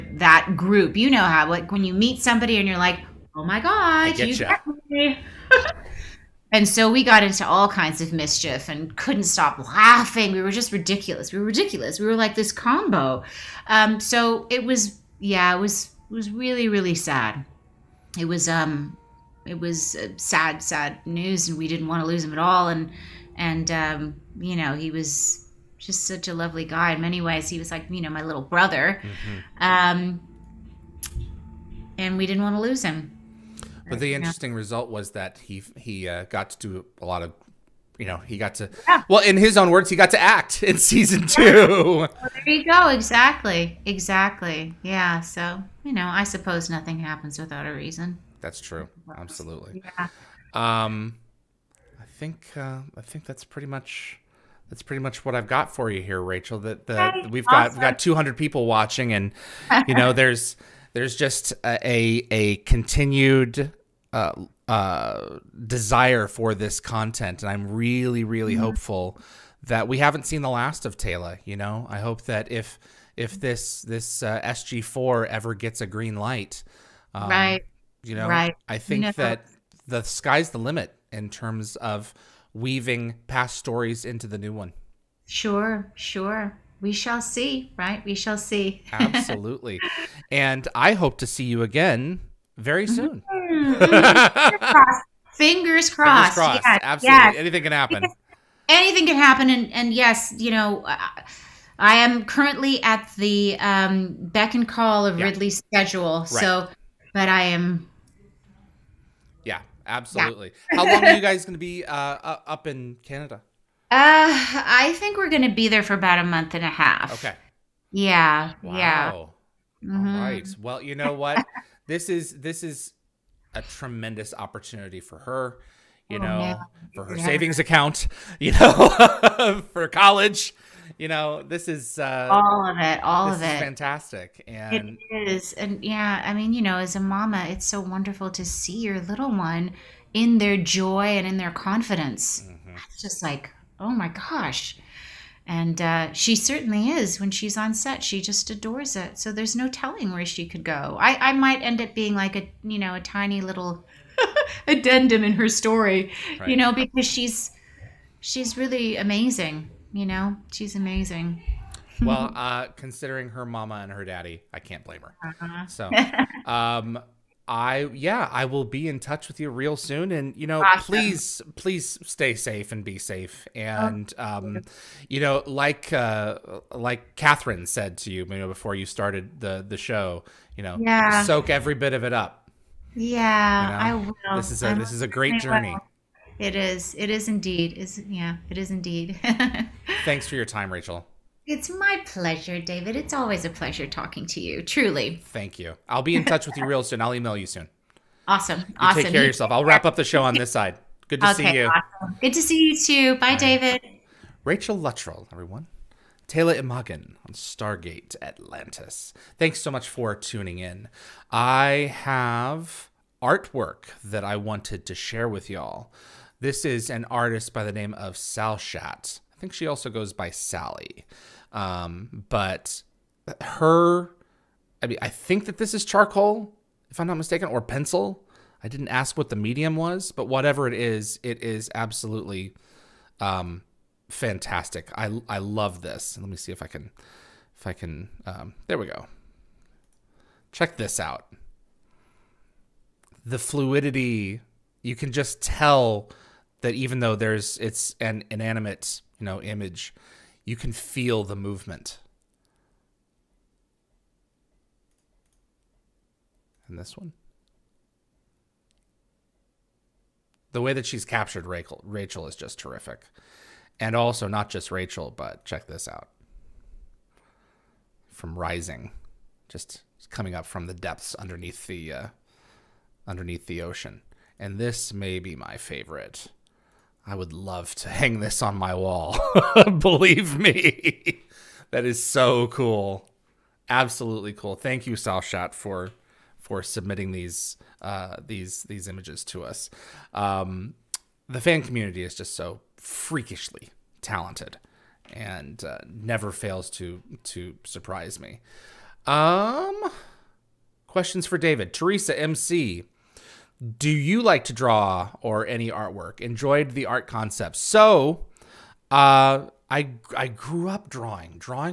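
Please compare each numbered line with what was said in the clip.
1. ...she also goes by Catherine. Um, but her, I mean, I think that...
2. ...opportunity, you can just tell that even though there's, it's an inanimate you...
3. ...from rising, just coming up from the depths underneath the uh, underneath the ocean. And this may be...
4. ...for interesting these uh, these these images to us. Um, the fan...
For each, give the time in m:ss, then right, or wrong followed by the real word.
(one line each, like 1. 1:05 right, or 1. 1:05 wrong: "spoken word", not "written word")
1. 3:39 wrong: "Sally", not "Catherine"
2. 4:03 wrong: "fluidity", not "opportunity"
3. 4:28 right
4. 4:46 wrong: "submitting", not "interesting".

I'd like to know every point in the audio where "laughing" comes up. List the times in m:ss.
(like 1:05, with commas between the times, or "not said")
0:09.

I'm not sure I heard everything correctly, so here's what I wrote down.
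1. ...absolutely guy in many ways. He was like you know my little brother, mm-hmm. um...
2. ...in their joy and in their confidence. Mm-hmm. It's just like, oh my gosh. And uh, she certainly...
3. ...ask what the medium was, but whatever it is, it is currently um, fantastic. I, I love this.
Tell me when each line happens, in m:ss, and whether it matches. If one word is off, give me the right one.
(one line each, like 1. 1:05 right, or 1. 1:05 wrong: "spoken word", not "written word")
1. 0:26 wrong: "lovely", not "absolutely"
2. 2:20 right
3. 3:48 wrong: "absolutely", not "currently".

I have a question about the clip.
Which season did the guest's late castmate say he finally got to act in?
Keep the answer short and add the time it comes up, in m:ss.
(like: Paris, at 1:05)
season 2, at 0:40.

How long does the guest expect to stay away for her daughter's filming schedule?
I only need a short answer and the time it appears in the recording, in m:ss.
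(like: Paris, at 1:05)
About a month and a half, at 1:55.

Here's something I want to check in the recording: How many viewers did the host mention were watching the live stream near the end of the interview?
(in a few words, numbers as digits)
200.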